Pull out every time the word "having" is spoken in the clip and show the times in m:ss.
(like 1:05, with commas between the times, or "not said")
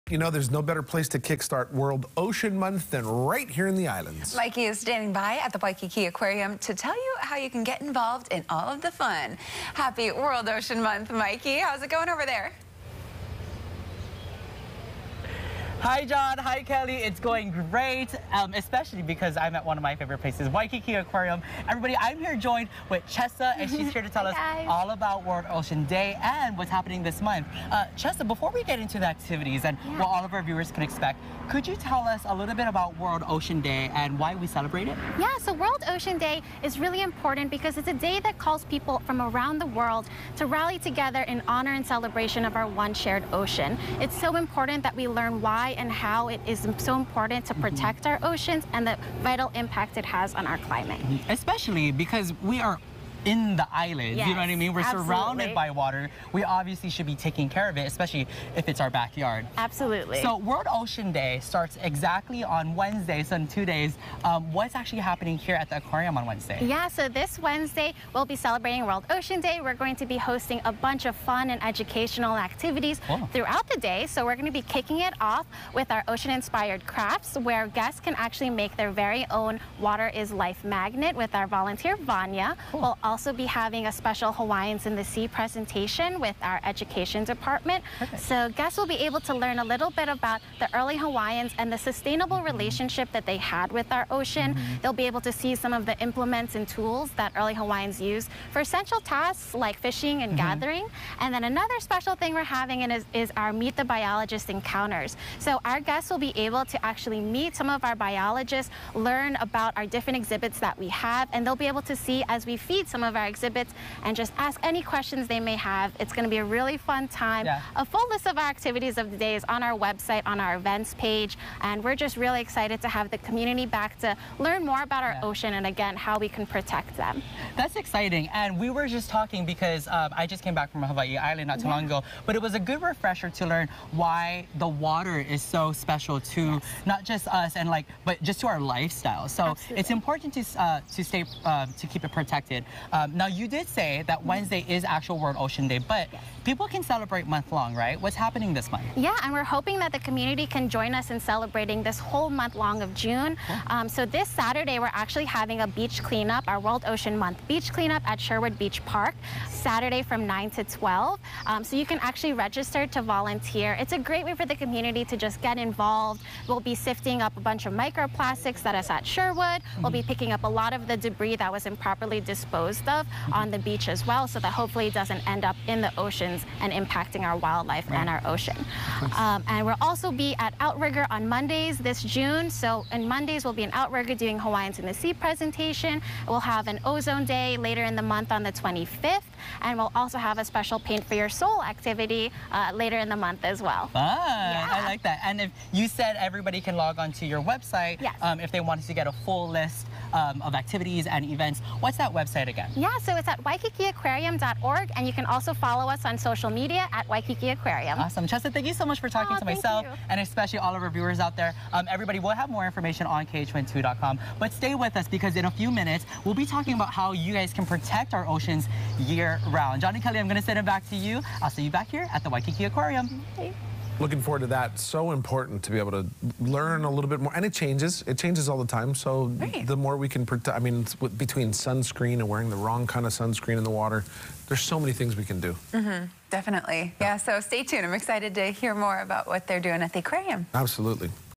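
1:23, 1:42, 2:35.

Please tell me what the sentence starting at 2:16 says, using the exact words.
not just us and like, but just to our lifestyle.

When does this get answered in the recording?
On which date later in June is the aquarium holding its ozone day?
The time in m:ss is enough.
3:08.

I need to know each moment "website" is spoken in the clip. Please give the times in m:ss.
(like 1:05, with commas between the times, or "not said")
1:59, 3:17, 3:22.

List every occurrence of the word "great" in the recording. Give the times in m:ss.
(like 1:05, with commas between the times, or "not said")
0:17, 2:43.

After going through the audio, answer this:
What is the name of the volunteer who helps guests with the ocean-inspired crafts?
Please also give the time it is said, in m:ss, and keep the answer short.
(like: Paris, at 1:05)
Vanya, at 1:21.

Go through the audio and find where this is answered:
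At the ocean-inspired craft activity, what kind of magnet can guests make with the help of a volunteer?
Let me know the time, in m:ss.
1:19.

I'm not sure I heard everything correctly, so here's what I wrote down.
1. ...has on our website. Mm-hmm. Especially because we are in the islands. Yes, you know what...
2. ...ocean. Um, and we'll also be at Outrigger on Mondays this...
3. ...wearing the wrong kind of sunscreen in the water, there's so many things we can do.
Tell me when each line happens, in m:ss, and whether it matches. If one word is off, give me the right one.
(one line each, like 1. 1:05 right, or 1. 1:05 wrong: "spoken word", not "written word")
1. 0:50 wrong: "climate", not "website"
2. 2:58 right
3. 3:52 right.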